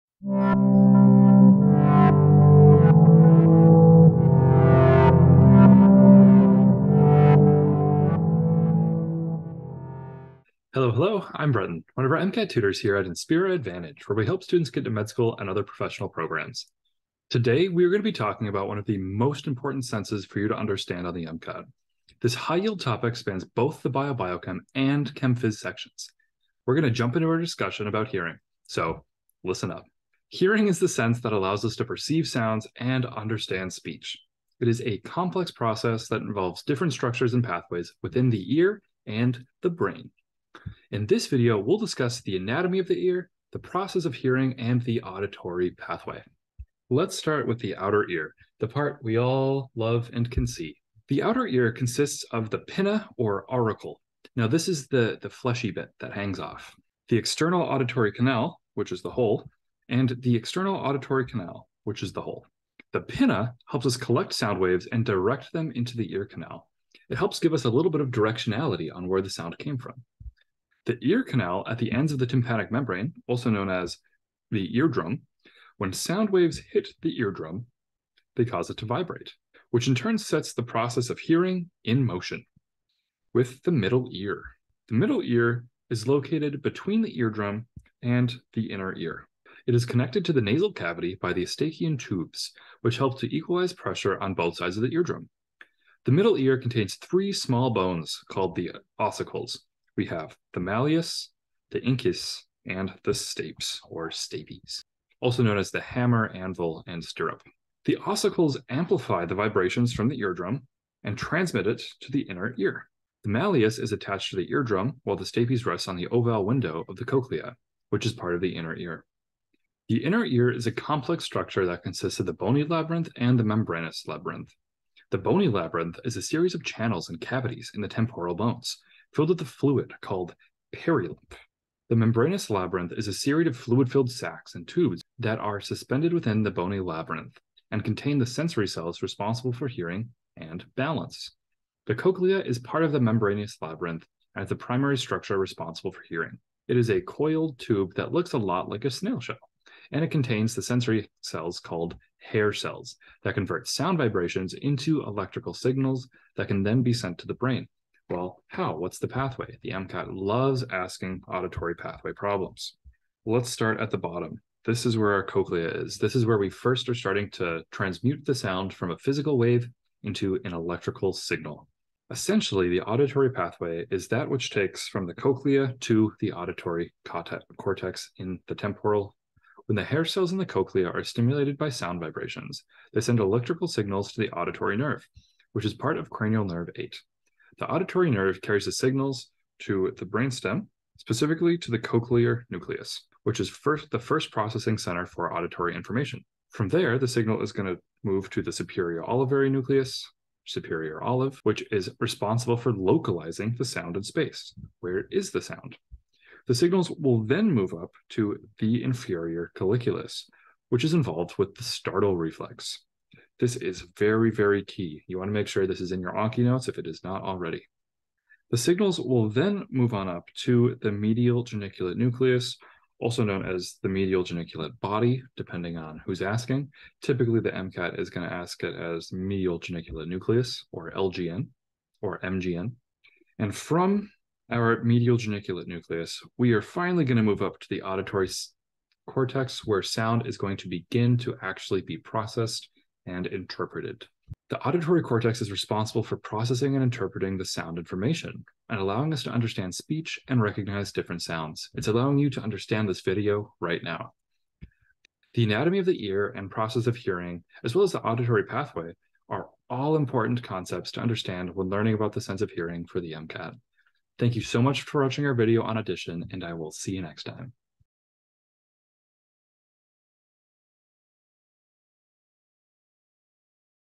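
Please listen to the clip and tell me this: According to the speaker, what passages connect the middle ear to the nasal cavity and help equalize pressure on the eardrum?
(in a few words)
Eustachian tubes.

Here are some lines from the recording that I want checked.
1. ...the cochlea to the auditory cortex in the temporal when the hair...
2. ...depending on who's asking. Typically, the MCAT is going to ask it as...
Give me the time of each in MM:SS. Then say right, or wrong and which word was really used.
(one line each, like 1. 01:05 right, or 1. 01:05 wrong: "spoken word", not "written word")
1. 02:55 right
2. 03:45 right.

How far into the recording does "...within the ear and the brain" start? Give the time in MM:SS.
00:38.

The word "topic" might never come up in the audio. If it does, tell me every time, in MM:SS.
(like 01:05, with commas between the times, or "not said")
00:22.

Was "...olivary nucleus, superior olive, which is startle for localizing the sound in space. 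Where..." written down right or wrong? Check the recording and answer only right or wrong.
wrong.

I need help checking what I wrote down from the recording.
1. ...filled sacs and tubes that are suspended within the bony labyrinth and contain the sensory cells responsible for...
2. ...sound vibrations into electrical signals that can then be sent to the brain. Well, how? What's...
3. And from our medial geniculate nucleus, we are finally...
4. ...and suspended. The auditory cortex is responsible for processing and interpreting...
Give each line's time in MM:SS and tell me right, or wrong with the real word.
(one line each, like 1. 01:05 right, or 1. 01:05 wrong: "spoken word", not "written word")
1. 02:13 right
2. 02:33 right
3. 03:53 right
4. 04:03 wrong: "interpreted", not "suspended".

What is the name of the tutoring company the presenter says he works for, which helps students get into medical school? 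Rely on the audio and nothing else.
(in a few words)
Inspira Advantage.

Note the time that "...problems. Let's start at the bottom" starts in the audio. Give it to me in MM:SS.
02:42.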